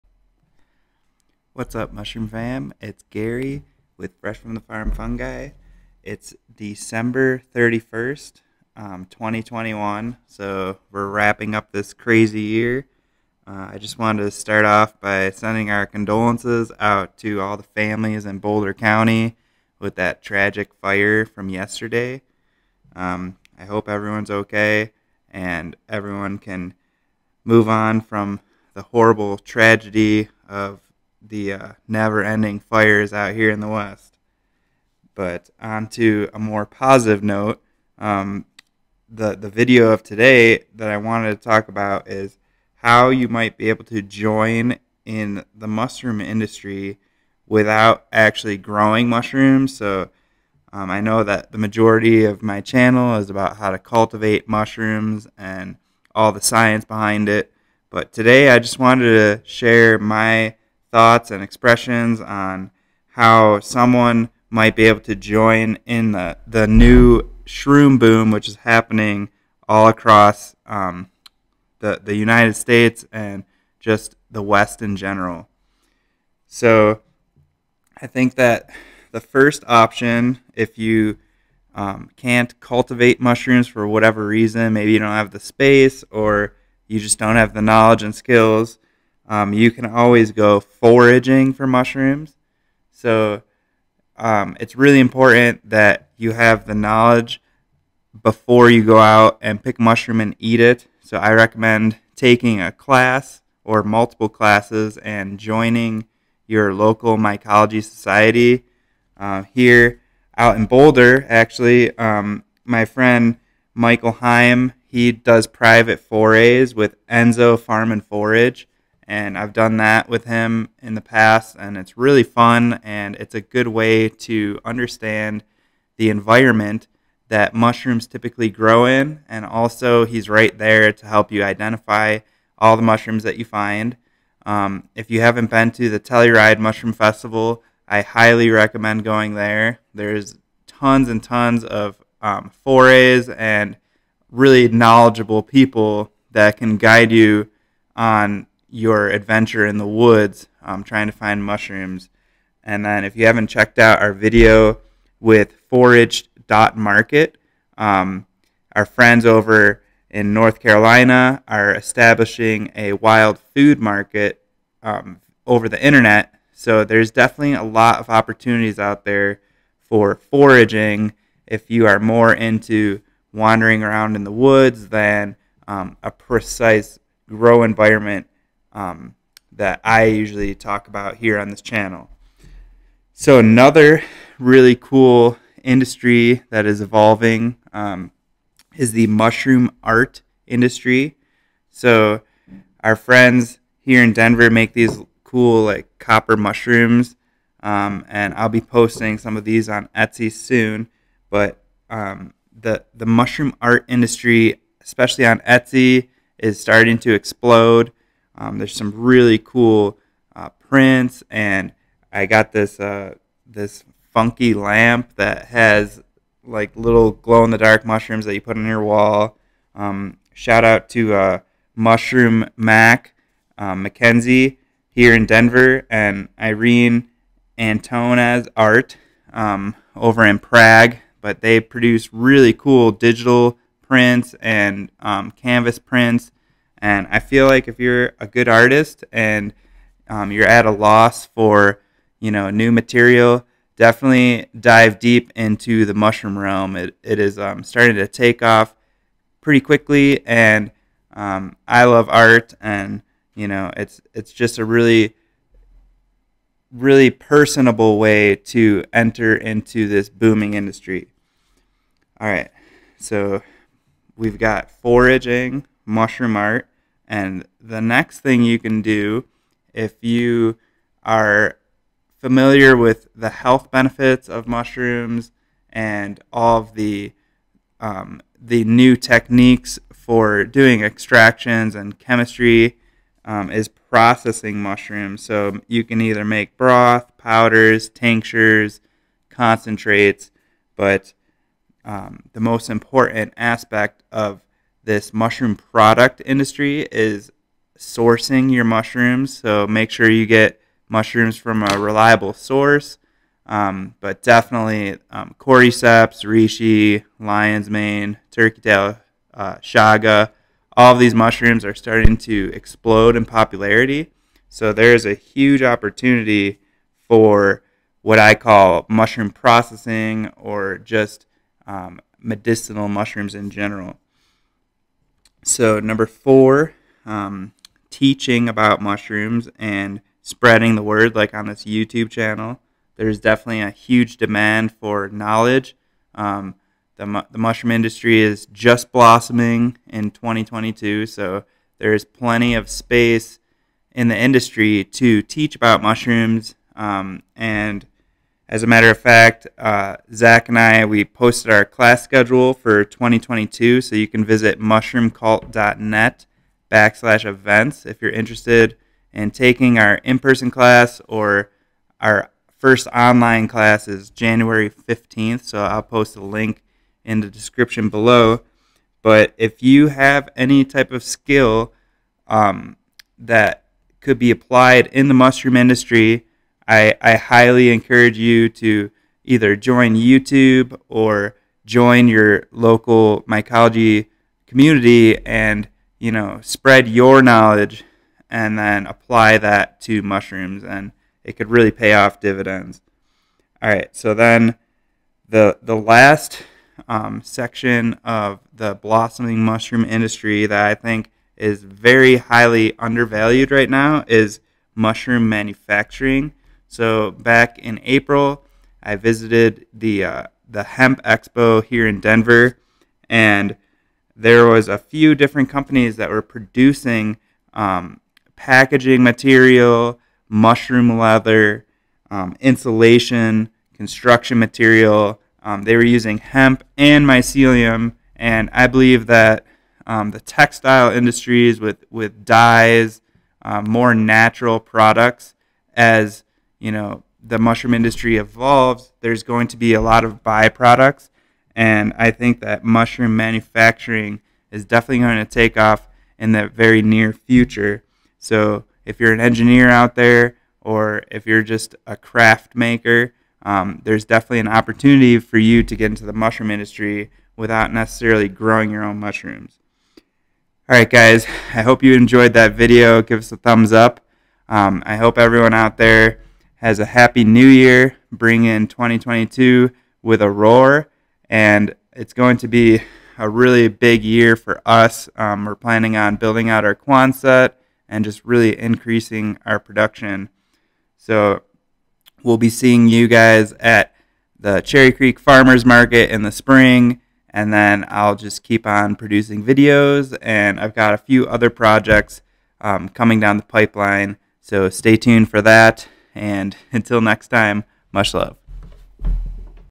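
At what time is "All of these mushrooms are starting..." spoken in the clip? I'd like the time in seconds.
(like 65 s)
310 s.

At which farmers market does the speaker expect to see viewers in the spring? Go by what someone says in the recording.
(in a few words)
Cherry Creek Farmers Market.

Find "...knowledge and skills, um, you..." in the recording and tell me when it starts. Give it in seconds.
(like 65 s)
87 s.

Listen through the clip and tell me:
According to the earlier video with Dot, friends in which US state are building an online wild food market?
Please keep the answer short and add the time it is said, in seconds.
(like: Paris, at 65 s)
North Carolina, at 160 s.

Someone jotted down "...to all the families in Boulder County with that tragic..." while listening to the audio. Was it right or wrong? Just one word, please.
right.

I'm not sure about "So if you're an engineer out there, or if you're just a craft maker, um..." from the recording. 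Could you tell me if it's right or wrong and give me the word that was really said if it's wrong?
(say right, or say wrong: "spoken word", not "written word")
right.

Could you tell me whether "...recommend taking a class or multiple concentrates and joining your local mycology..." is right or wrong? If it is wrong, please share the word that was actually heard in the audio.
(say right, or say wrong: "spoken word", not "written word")
wrong: "classes", not "concentrates".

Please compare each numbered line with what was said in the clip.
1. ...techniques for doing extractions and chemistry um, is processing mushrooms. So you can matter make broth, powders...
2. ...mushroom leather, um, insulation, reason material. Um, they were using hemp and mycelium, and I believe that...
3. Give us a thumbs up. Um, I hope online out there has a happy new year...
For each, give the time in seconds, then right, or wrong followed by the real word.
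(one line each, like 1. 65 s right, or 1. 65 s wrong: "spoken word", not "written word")
1. 278 s wrong: "either", not "matter"
2. 420 s wrong: "construction", not "reason"
3. 463 s wrong: "everyone", not "online".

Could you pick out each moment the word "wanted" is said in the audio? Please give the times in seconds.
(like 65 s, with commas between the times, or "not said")
13 s, 40 s, 58 s.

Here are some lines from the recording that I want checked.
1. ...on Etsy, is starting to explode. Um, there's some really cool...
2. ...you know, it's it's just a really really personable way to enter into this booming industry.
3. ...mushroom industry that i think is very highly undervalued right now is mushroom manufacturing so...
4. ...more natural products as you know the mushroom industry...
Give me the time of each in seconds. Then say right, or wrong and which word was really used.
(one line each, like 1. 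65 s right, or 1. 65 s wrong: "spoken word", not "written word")
1. 205 s right
2. 253 s right
3. 399 s right
4. 433 s right.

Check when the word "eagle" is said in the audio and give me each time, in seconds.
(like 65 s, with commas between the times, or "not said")
not said.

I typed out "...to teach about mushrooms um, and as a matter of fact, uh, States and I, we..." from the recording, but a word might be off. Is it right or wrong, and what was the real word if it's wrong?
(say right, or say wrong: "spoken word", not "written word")
wrong: "Zach", not "States".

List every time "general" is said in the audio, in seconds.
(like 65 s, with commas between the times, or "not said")
74 s, 323 s.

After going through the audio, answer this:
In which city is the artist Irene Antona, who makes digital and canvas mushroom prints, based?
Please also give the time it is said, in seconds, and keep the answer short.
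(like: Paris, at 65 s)
Prague, at 230 s.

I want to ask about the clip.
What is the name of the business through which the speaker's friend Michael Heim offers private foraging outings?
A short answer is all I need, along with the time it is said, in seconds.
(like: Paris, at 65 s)
Enso Farm and Forage, at 117 s.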